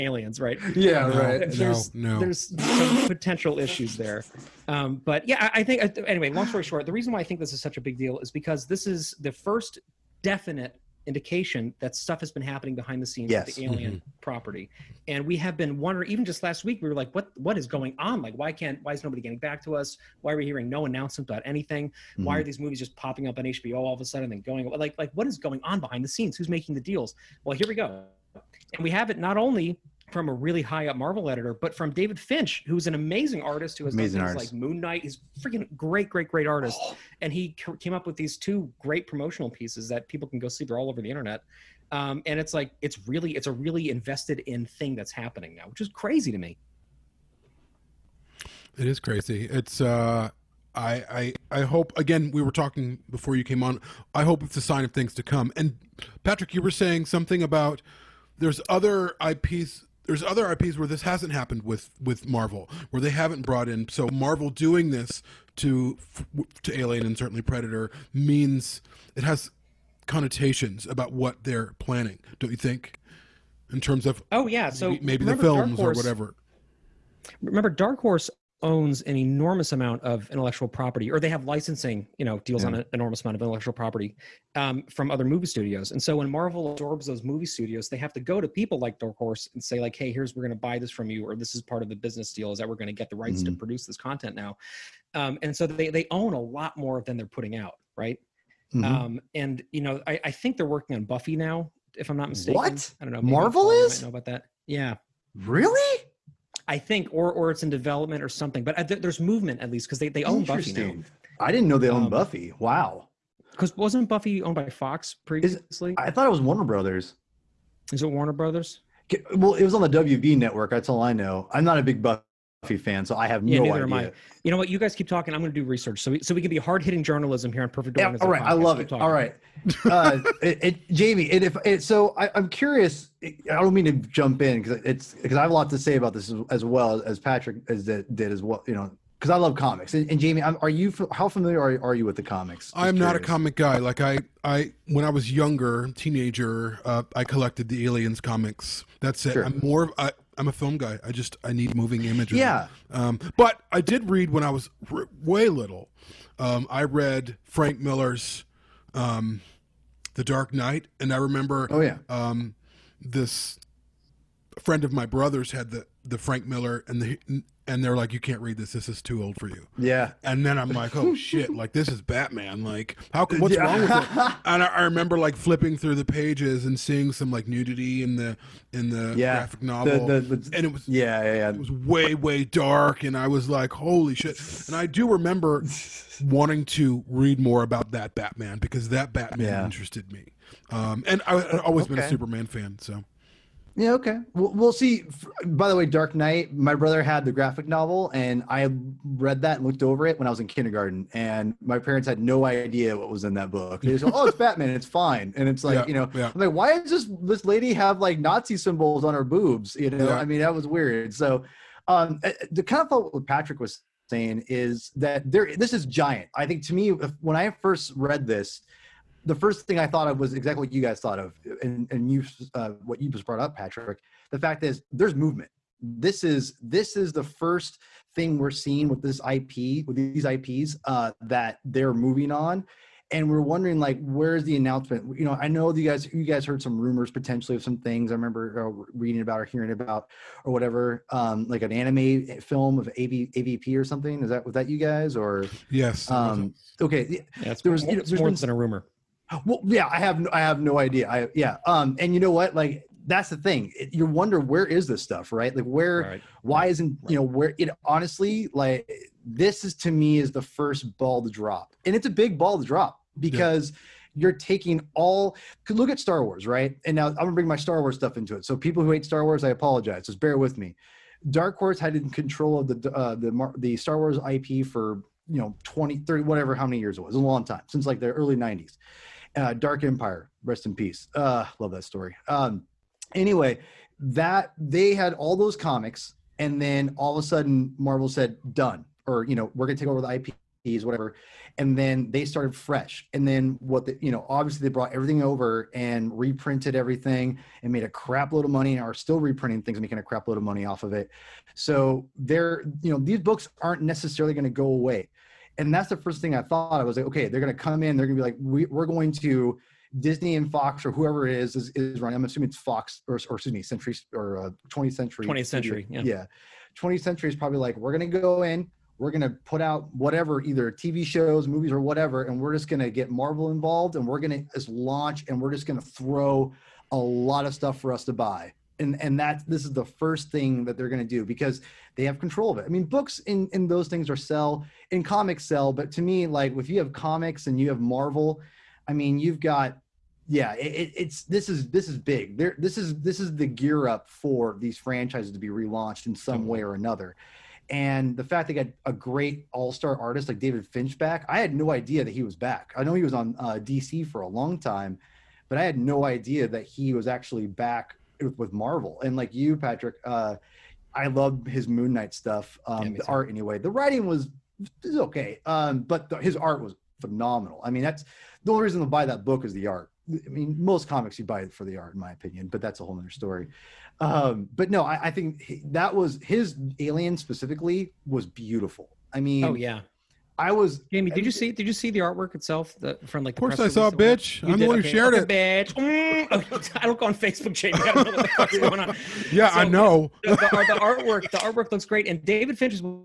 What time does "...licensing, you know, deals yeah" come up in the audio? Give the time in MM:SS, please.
01:21.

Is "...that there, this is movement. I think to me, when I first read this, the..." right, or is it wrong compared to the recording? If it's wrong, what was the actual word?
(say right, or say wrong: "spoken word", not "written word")
wrong: "giant", not "movement".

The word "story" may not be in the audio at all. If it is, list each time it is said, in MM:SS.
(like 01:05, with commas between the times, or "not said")
00:06, 04:41, 06:13.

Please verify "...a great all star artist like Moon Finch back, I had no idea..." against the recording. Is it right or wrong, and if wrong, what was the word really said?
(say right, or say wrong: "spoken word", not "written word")
wrong: "David", not "Moon".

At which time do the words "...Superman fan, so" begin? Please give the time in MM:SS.
03:12.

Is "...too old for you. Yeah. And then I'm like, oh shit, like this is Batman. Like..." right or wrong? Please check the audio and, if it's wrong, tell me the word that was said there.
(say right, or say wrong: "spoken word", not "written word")
right.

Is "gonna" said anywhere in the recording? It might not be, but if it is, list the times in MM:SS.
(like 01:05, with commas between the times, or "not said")
04:27, 04:49, 05:04.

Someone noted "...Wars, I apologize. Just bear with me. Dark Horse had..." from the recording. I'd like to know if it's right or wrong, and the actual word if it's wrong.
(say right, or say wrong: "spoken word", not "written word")
right.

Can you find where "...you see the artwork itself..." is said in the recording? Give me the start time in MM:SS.
06:21.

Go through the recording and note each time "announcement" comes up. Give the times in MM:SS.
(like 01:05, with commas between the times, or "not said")
00:20, 03:54.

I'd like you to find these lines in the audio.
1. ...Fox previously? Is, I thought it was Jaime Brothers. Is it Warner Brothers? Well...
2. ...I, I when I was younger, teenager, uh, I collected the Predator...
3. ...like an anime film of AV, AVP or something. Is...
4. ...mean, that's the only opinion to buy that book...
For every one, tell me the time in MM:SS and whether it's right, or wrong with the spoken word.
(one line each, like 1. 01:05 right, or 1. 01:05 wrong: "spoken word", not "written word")
1. 01:54 wrong: "Warner", not "Jaime"
2. 02:23 wrong: "Aliens", not "Predator"
3. 04:01 right
4. 06:07 wrong: "reason", not "opinion".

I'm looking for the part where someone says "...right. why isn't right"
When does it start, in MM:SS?
04:16.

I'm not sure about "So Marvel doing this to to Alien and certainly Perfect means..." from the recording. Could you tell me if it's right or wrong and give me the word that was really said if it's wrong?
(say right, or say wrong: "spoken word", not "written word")
wrong: "Predator", not "Perfect".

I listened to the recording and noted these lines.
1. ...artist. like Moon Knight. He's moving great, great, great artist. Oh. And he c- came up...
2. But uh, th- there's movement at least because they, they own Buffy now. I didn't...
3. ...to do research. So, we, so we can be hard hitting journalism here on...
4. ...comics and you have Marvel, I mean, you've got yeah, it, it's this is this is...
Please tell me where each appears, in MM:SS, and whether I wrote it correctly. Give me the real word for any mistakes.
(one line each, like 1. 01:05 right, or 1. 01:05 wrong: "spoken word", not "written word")
1. 00:34 wrong: "freaking", not "moving"
2. 01:48 right
3. 02:05 right
4. 05:36 right.